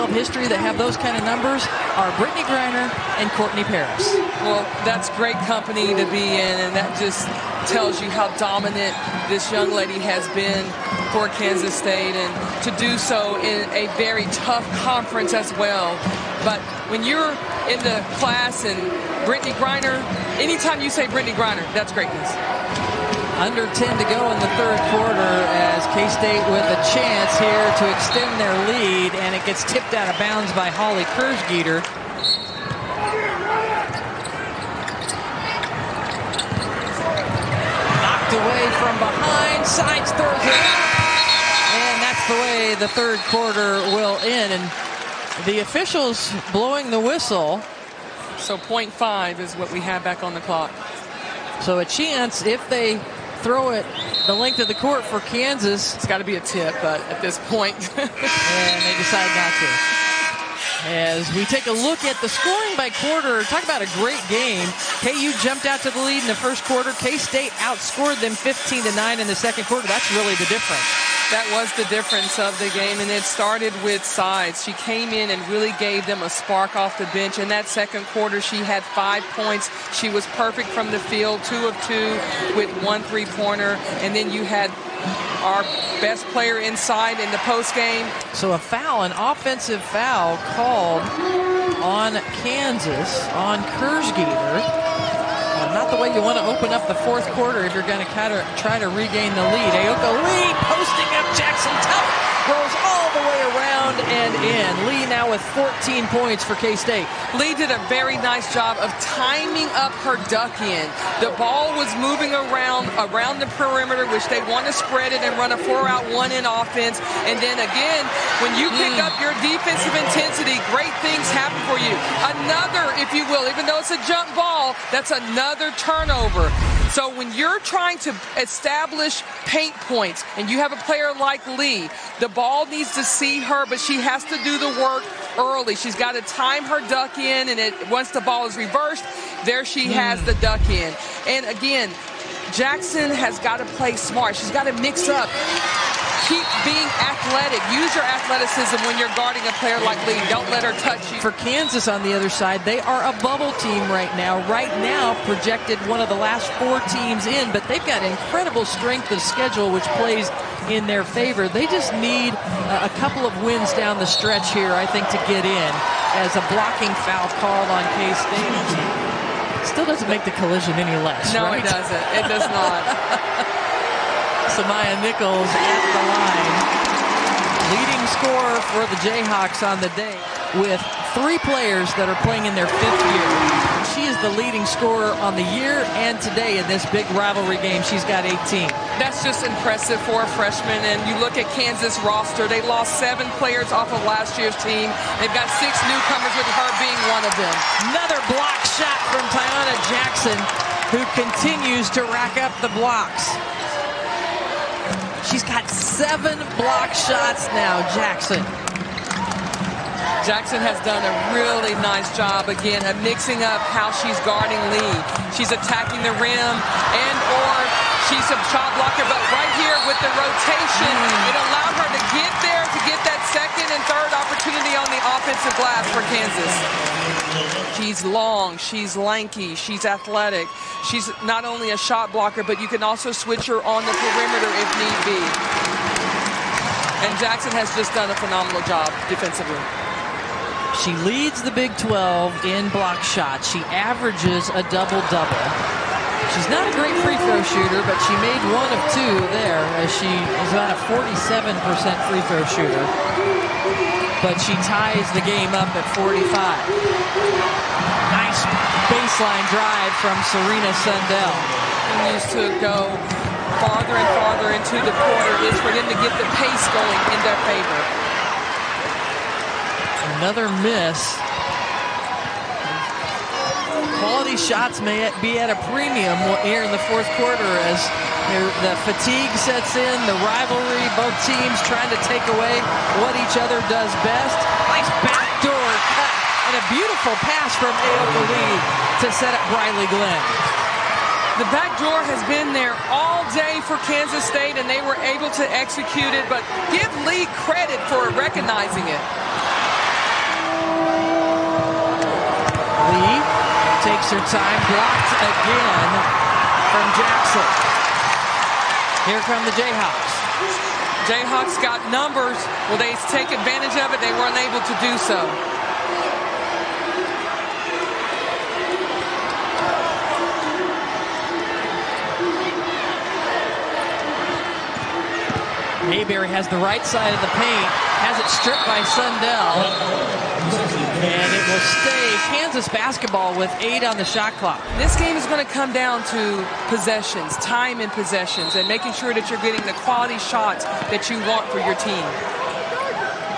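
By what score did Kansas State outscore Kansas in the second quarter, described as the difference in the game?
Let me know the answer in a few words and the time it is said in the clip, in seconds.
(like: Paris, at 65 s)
15 to 9, at 68 s.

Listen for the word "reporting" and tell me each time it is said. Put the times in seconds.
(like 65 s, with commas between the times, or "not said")
not said.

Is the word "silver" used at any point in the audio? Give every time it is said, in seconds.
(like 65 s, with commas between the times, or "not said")
not said.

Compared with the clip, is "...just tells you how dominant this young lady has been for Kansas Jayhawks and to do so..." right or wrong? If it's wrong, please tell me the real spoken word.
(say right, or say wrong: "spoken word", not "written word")
wrong: "State", not "Jayhawks".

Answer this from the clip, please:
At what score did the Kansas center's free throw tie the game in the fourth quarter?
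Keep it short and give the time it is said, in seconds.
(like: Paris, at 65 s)
45, at 255 s.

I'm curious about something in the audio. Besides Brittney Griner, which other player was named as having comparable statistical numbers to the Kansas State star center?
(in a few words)
Courtney Paris.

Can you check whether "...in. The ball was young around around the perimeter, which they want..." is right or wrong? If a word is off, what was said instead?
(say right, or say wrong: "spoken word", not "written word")
wrong: "moving", not "young".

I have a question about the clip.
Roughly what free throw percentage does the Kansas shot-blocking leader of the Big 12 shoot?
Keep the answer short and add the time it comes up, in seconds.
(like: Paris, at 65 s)
47%, at 250 s.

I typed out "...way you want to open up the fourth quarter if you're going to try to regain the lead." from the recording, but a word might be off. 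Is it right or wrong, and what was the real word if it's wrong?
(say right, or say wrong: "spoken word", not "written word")
right.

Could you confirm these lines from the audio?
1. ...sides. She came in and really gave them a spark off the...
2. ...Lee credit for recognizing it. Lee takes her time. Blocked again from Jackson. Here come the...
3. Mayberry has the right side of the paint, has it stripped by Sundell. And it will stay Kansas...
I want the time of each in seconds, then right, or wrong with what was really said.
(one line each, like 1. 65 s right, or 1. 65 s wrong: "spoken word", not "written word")
1. 74 s right
2. 297 s right
3. 325 s right.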